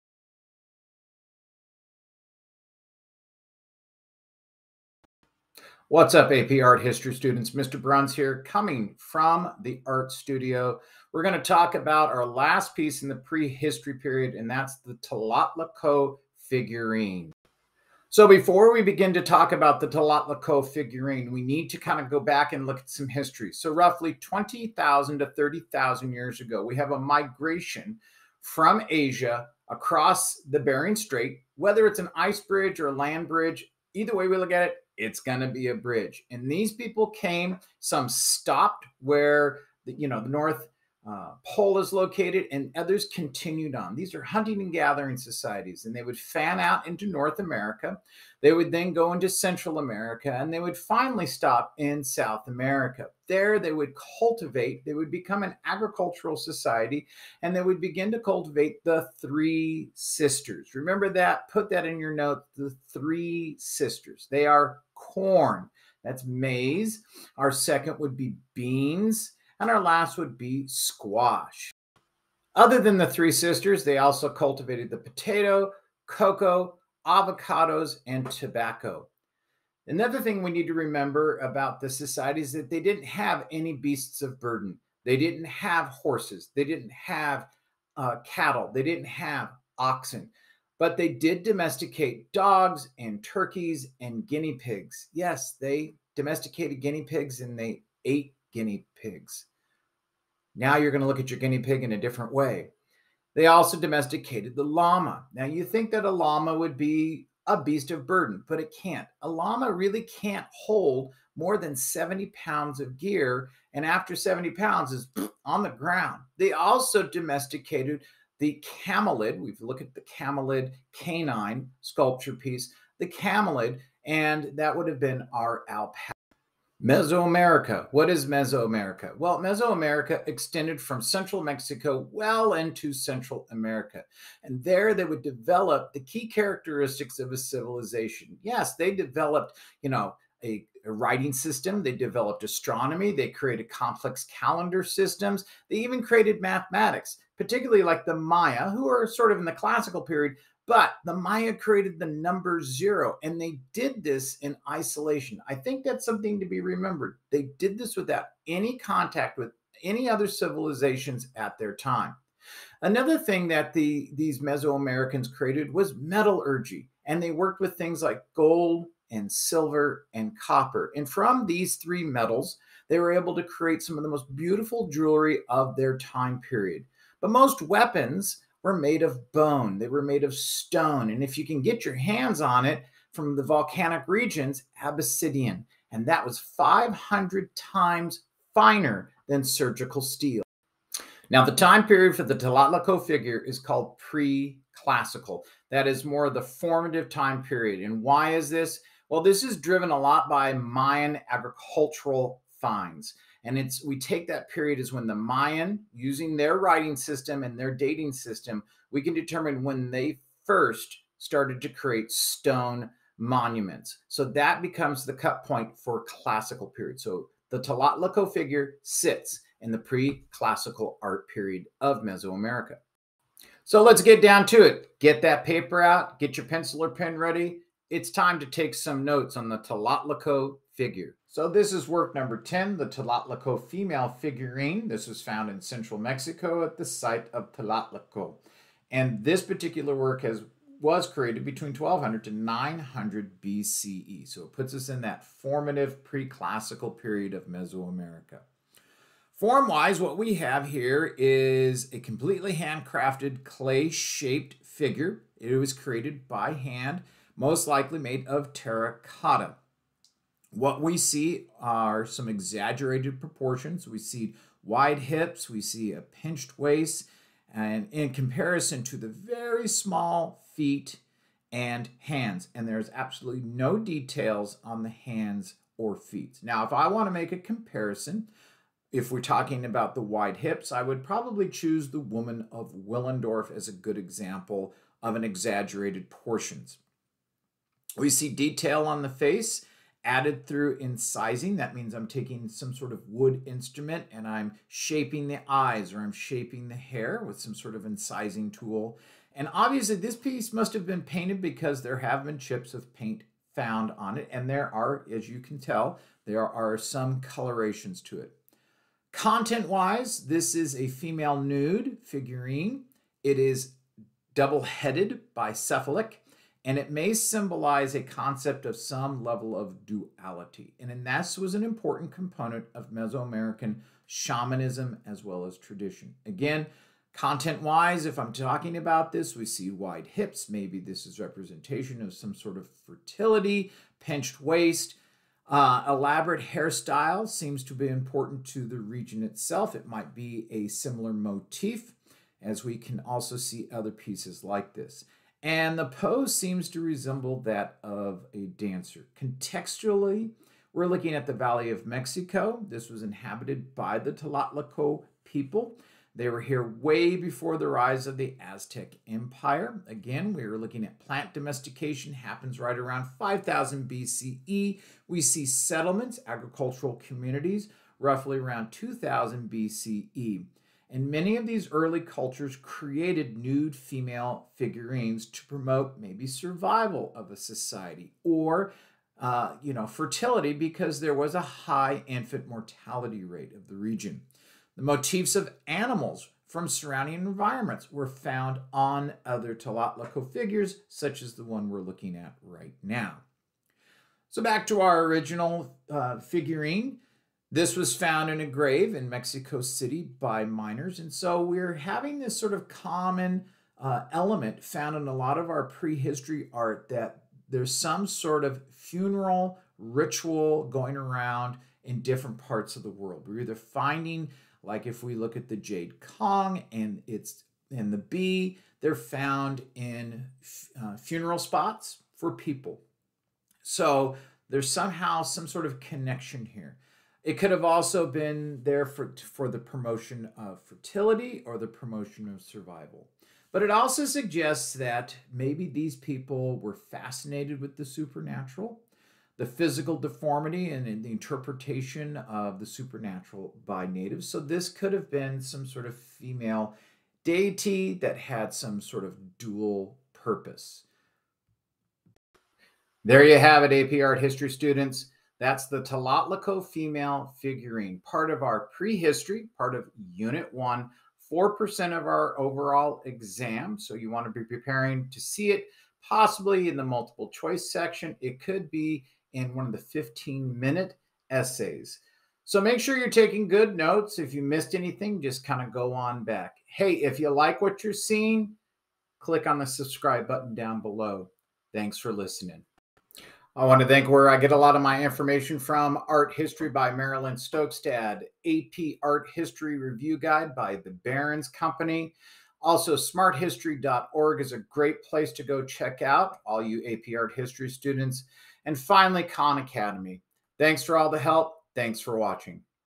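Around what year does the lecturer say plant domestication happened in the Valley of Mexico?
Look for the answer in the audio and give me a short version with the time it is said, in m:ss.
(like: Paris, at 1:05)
5000 BCE, at 6:03.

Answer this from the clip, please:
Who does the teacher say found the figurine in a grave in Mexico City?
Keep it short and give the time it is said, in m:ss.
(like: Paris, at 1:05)
Miners, at 6:40.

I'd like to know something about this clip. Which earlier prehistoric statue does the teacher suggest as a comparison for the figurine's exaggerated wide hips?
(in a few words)
Woman of Willendorf.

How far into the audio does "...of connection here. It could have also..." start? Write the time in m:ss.
7:05.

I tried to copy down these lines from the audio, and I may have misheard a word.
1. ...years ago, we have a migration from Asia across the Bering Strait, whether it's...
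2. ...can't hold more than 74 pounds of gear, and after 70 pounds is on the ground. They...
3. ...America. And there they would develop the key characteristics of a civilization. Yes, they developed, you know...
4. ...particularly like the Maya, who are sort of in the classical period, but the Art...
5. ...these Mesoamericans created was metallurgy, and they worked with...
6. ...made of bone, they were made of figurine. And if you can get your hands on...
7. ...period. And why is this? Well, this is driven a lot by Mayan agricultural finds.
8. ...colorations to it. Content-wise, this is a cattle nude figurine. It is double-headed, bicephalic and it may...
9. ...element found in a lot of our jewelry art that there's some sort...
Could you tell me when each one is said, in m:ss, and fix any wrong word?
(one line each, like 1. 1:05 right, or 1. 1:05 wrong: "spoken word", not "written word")
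1. 0:26 right
2. 1:50 wrong: "70", not "74"
3. 2:13 right
4. 2:27 wrong: "Maya", not "Art"
5. 2:44 right
6. 2:58 wrong: "stone", not "figurine"
7. 3:17 right
8. 5:07 wrong: "female", not "cattle"
9. 6:44 wrong: "prehistory", not "jewelry".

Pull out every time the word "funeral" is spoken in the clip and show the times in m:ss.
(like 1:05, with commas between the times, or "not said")
6:48, 7:00.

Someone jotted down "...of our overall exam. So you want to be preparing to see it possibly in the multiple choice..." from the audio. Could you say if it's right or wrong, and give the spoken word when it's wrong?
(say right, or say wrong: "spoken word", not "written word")
right.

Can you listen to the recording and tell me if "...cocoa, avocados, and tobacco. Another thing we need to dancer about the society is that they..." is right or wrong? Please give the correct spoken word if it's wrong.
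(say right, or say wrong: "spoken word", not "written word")
wrong: "remember", not "dancer".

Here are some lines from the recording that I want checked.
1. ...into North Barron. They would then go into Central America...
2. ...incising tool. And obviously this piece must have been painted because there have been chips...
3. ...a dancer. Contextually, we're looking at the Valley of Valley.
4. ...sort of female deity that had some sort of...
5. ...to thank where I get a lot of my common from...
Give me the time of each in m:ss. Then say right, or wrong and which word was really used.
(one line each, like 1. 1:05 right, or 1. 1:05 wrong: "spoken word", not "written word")
1. 0:46 wrong: "America", not "Barron"
2. 4:57 right
3. 5:48 wrong: "Mexico", not "Valley"
4. 7:25 right
5. 8:03 wrong: "information", not "common".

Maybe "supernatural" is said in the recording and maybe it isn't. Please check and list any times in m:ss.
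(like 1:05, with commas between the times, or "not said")
7:17, 7:22.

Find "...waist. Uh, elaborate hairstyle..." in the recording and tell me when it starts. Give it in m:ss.
5:34.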